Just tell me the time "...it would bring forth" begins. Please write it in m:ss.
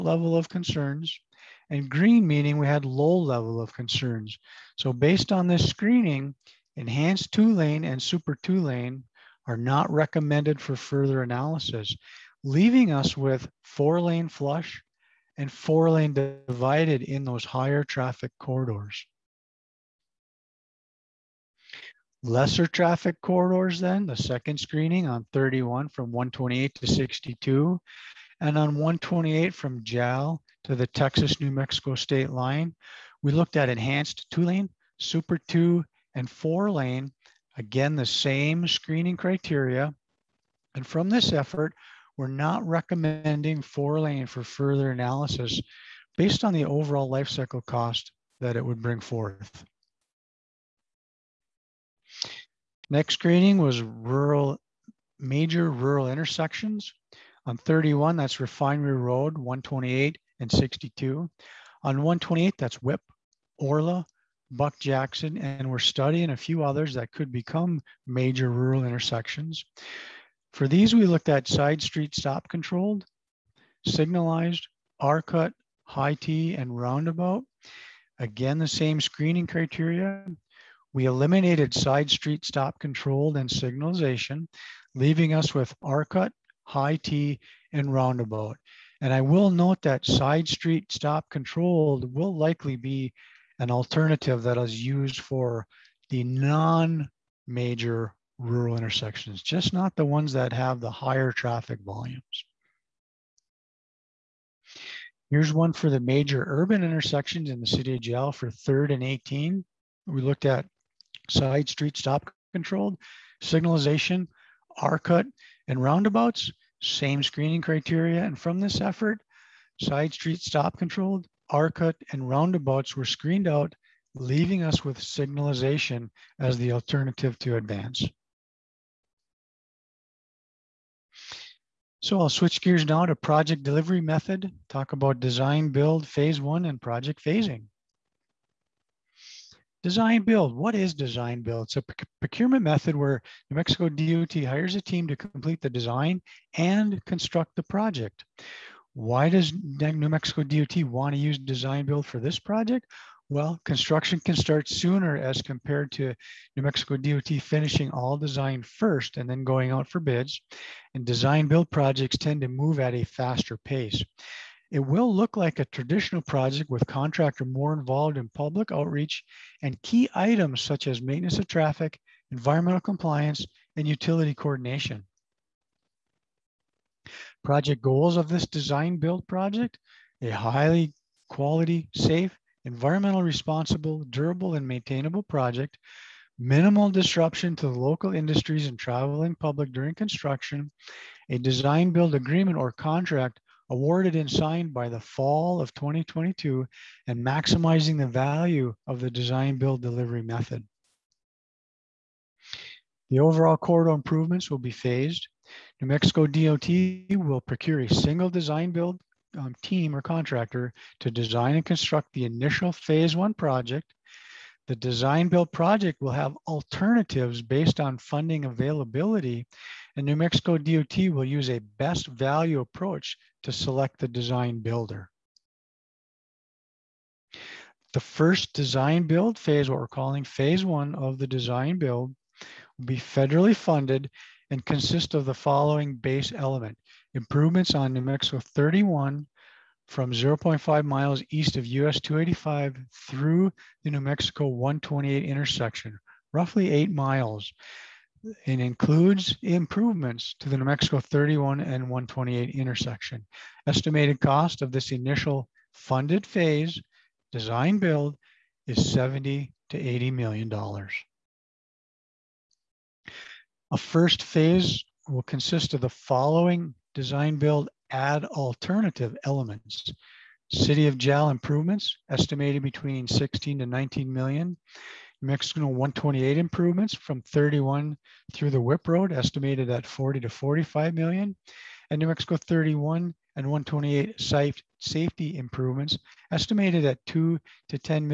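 0:48.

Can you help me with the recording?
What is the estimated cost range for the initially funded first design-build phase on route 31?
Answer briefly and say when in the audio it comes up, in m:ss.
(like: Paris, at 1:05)
70 to 80 million dollars, at 4:18.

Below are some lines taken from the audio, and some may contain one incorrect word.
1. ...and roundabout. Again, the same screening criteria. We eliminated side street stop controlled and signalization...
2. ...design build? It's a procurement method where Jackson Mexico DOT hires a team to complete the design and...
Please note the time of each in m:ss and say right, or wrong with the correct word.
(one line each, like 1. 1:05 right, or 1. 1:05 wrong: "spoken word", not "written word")
1. 1:16 right
2. 2:20 wrong: "New", not "Jackson".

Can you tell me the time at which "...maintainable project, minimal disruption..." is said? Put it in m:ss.
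3:04.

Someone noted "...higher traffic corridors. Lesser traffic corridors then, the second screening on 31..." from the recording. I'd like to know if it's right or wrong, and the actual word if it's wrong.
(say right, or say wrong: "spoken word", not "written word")
right.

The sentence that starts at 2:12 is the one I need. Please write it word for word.
So I'll switch gears now to project delivery method, talk about design, build, phase one, and project phasing.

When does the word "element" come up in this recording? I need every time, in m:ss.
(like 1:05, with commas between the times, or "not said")
3:56, 4:29.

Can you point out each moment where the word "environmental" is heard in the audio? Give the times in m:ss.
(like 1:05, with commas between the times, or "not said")
2:52, 3:02.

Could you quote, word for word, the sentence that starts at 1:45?
Here's one for the major urban intersections in the city of Jal for 3rd and 18.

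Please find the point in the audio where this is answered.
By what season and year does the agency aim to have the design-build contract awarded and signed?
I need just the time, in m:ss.
3:14.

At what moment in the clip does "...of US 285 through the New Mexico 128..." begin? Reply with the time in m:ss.
4:01.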